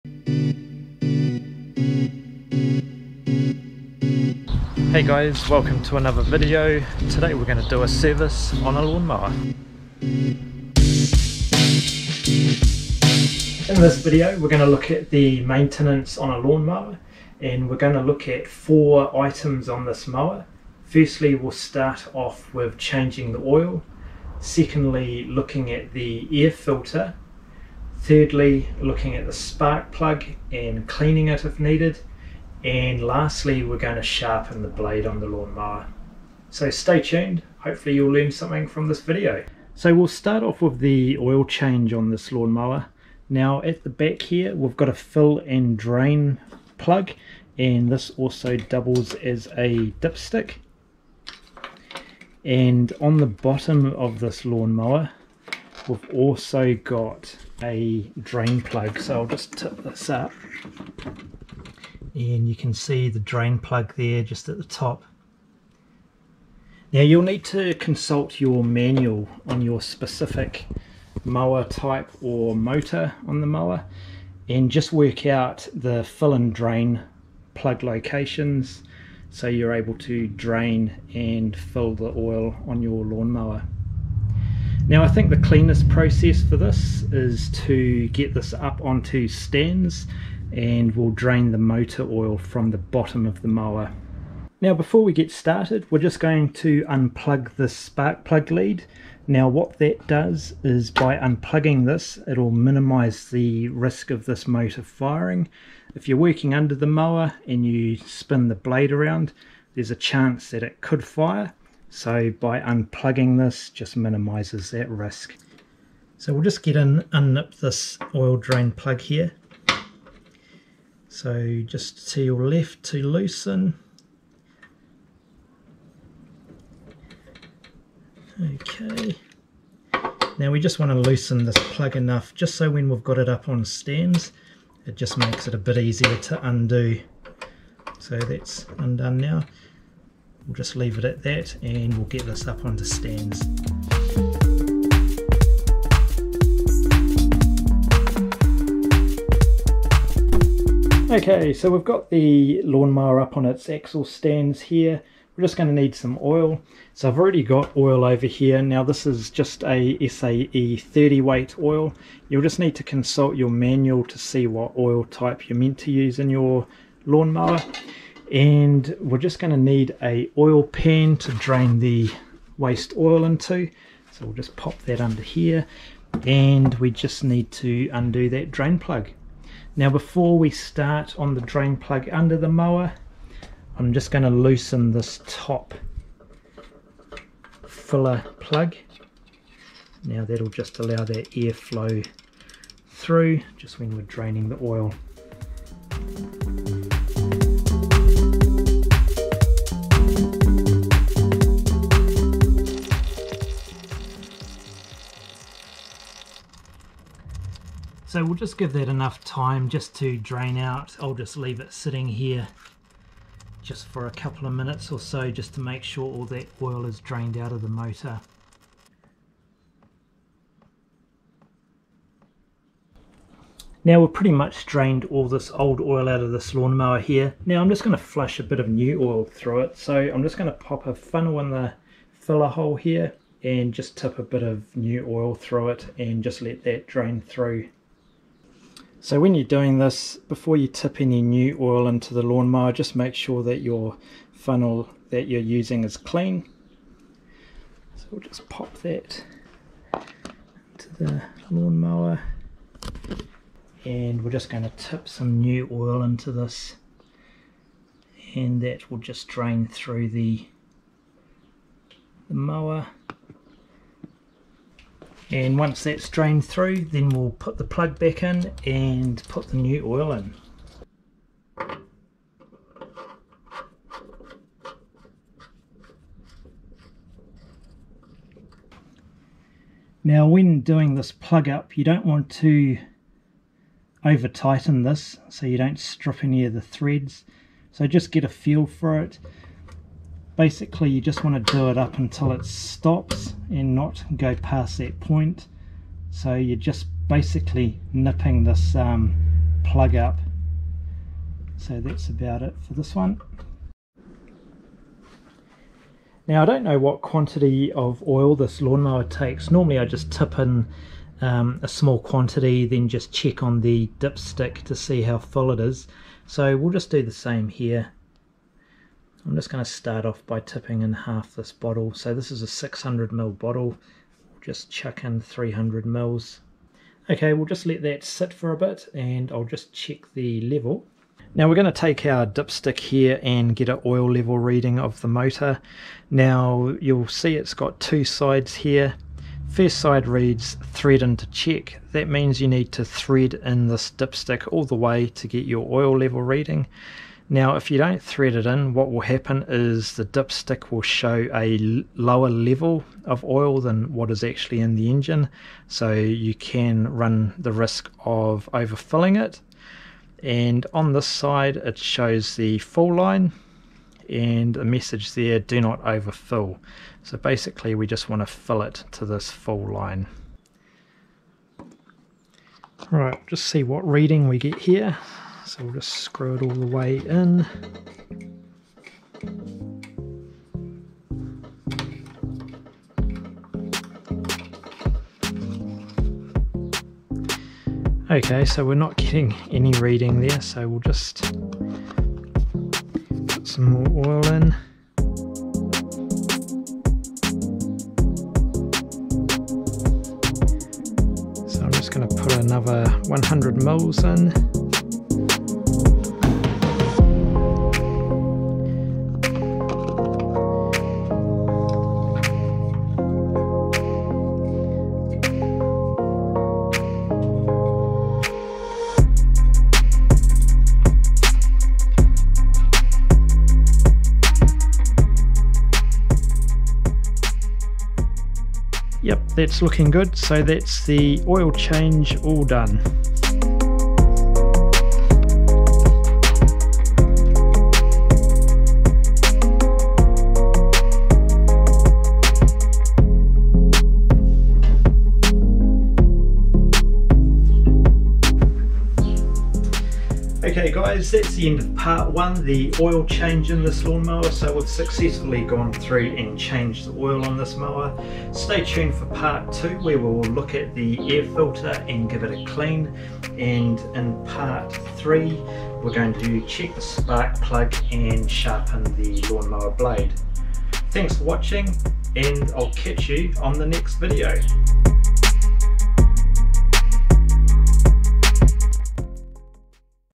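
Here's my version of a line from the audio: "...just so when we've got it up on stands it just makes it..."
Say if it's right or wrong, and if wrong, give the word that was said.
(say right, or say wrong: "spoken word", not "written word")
right.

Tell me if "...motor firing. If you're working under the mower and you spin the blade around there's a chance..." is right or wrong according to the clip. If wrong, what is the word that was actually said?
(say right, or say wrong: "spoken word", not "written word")
right.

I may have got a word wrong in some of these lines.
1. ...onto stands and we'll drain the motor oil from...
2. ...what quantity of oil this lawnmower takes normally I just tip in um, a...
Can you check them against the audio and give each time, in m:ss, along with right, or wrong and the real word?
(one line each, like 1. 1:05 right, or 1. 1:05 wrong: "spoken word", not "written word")
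1. 1:28 right
2. 5:06 right.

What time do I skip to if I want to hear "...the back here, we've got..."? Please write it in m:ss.
0:43.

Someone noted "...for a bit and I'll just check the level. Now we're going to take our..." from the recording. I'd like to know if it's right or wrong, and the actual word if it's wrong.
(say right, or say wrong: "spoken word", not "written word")
right.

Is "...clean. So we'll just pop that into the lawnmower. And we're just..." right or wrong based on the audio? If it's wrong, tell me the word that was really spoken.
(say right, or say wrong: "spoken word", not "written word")
right.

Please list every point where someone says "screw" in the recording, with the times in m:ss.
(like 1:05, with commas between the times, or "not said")
6:15.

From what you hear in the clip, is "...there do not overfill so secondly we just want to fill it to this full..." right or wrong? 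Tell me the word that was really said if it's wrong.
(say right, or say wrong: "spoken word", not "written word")
wrong: "basically", not "secondly".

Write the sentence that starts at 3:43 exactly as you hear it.
Now we've pretty much drained all this old oil out of this lawnmower here.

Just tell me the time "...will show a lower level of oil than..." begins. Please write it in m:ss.
5:50.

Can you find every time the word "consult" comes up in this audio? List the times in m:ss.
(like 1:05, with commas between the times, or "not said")
1:07, 2:42.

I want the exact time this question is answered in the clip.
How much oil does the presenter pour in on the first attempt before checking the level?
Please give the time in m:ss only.
5:25.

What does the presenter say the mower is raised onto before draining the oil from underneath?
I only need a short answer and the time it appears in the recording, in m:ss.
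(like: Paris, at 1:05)
axle stands, at 2:33.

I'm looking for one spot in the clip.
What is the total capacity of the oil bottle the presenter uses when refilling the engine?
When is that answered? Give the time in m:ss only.
5:22.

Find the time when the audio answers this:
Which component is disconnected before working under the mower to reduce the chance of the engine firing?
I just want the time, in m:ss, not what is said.
1:37.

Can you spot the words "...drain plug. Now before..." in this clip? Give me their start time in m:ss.
2:58.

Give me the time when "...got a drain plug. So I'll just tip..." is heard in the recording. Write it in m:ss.
0:56.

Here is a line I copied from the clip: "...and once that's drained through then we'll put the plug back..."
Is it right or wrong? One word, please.
right.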